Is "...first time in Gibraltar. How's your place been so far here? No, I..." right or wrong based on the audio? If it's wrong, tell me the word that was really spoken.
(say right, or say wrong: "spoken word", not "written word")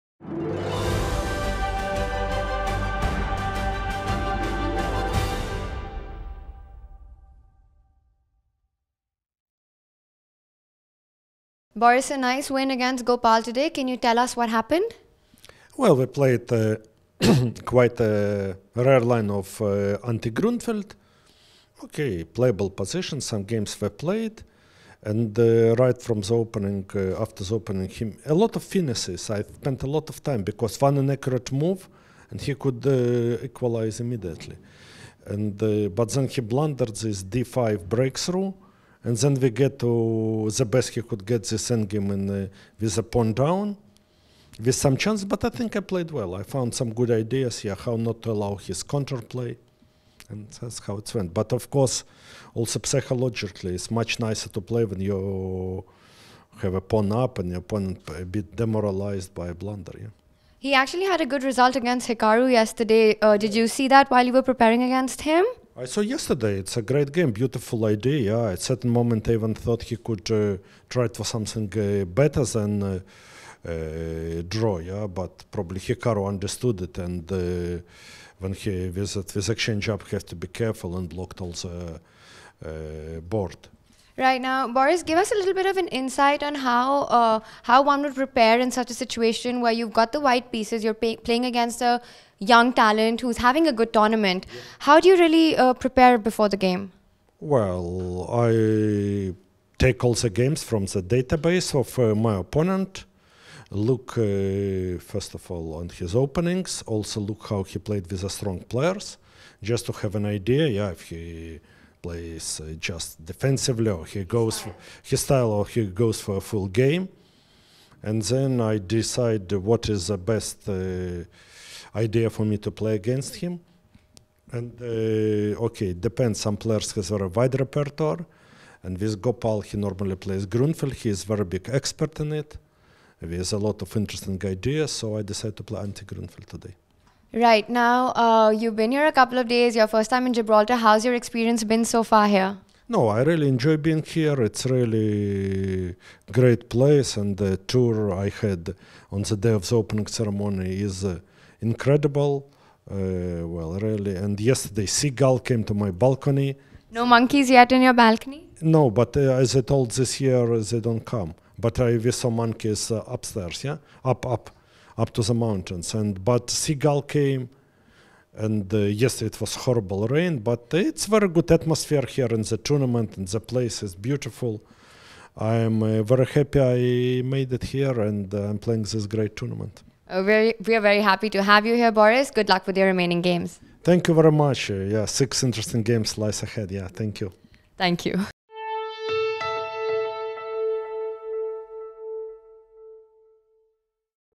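wrong: "experience", not "place".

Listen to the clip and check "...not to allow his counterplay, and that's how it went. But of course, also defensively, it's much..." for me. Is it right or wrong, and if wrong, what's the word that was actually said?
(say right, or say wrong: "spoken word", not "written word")
wrong: "psychologically", not "defensively".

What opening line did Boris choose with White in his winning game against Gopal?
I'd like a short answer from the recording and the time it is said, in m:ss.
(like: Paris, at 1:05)
anti-Grunfeld, at 0:20.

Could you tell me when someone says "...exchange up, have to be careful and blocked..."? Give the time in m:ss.
1:19.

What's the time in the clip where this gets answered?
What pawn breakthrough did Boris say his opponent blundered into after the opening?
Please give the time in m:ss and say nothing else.
0:37.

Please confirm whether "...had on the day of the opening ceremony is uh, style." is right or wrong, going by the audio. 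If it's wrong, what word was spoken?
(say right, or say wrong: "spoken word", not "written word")
wrong: "incredible", not "style".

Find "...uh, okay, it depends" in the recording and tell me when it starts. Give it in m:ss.
2:04.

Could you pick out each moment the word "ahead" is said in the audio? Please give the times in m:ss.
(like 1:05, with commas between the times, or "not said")
3:06.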